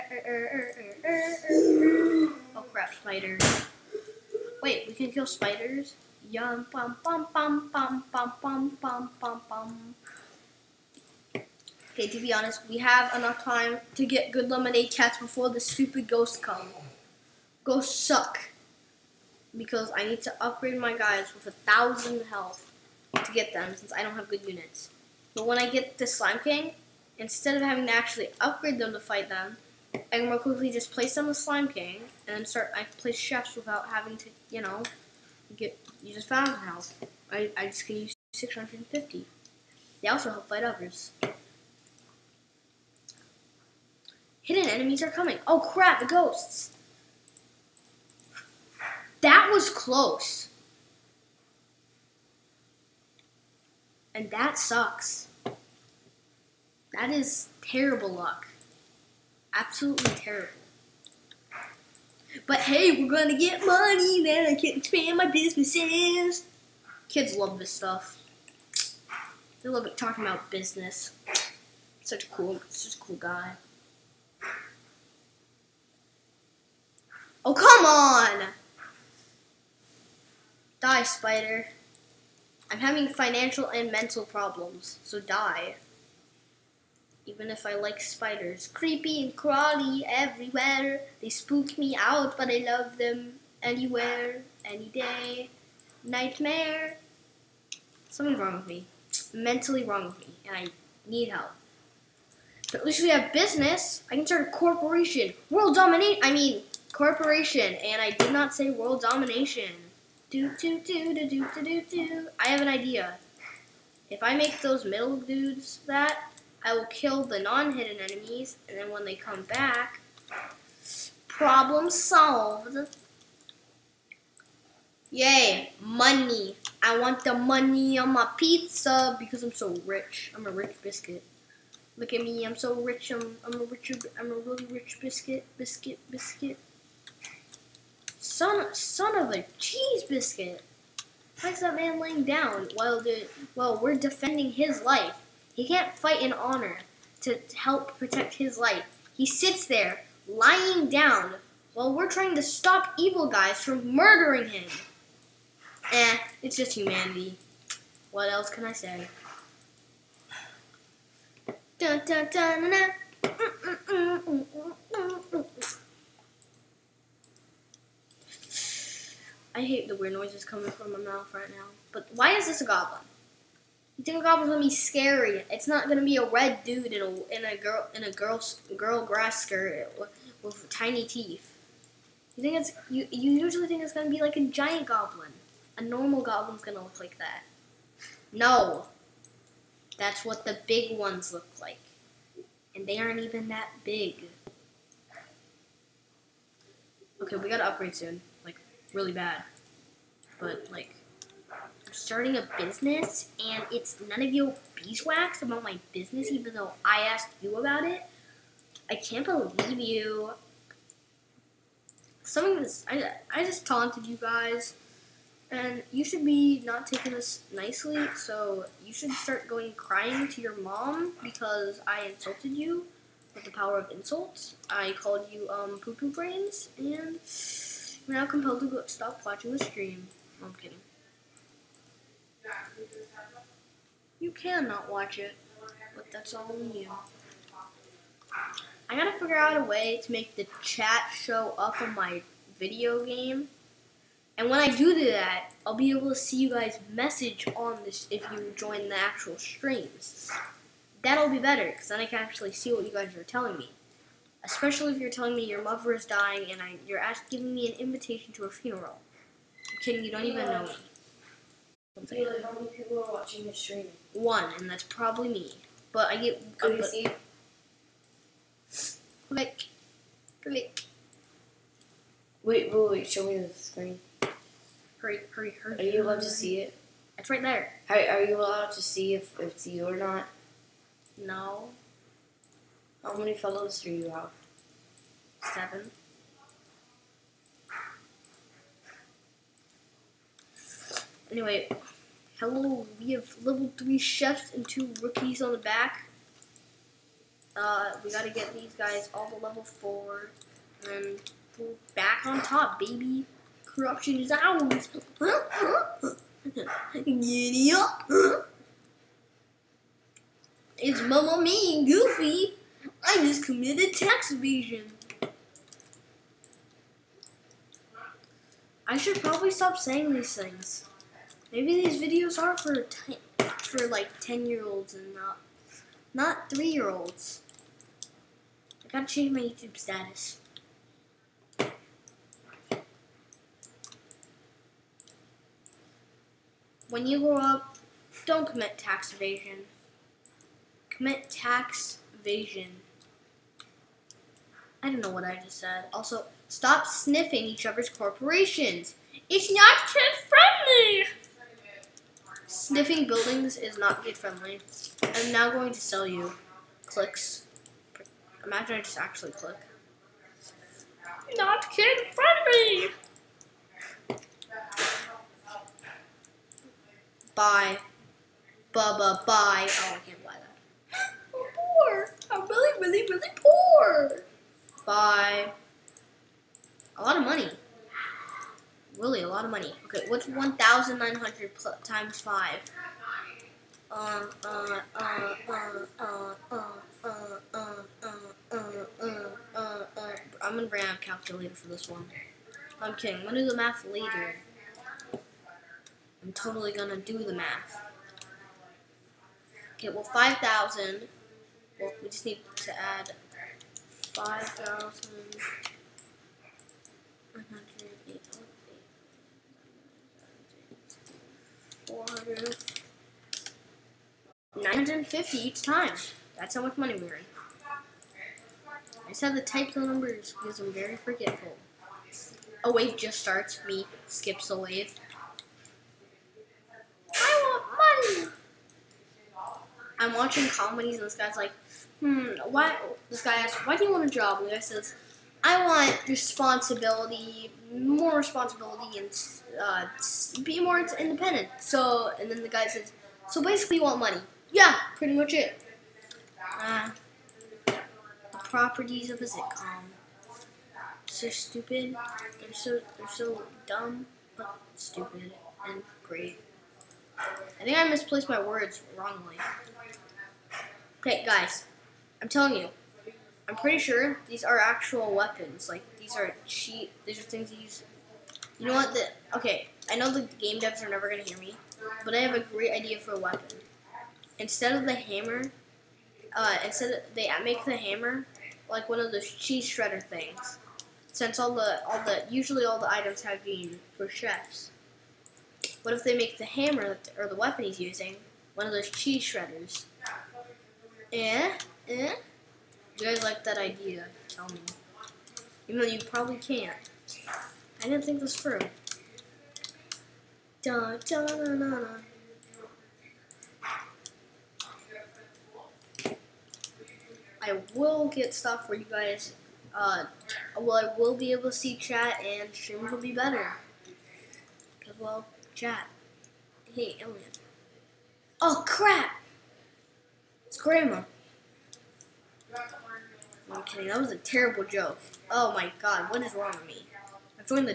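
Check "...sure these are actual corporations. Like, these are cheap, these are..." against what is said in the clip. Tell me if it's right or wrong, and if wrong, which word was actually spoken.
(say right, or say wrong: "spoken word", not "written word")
wrong: "weapons", not "corporations".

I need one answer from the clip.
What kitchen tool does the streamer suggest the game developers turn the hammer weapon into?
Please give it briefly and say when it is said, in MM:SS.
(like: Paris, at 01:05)
cheese shredder, at 07:59.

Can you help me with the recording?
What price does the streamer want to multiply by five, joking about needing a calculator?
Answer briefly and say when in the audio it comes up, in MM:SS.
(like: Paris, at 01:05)
1,900, at 06:20.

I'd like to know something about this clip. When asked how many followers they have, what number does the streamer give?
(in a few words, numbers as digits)
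7.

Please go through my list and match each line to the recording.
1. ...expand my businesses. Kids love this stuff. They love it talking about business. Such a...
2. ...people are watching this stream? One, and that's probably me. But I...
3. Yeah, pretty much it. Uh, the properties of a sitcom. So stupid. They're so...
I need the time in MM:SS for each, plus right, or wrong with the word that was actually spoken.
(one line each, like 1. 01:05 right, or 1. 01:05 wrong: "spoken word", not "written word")
1. 01:04 right
2. 04:22 right
3. 07:24 right.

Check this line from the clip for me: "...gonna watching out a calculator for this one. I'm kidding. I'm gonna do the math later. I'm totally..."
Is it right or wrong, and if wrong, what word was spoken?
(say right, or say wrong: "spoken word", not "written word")
wrong: "bring", not "watching".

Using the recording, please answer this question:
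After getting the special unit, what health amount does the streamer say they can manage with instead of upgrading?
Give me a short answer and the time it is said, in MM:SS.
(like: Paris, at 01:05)
650, at 00:38.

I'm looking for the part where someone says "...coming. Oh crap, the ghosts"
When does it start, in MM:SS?
00:45.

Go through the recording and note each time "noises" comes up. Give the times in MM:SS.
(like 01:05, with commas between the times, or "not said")
02:50.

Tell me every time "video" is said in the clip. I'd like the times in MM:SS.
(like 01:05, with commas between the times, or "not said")
04:02, 05:22.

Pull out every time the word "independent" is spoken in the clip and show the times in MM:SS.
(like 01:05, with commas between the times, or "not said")
07:20.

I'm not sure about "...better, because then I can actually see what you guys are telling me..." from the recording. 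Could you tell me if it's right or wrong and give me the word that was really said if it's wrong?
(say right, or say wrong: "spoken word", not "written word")
right.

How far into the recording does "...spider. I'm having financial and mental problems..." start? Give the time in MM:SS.
01:21.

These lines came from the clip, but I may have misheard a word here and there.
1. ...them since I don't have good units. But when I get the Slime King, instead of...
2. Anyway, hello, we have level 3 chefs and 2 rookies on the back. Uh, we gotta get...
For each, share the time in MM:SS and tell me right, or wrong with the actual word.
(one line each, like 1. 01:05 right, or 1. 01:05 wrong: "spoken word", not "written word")
1. 00:23 right
2. 04:51 right.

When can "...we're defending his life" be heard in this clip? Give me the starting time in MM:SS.
02:23.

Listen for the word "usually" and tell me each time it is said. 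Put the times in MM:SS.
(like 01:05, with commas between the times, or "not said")
03:03, 08:02.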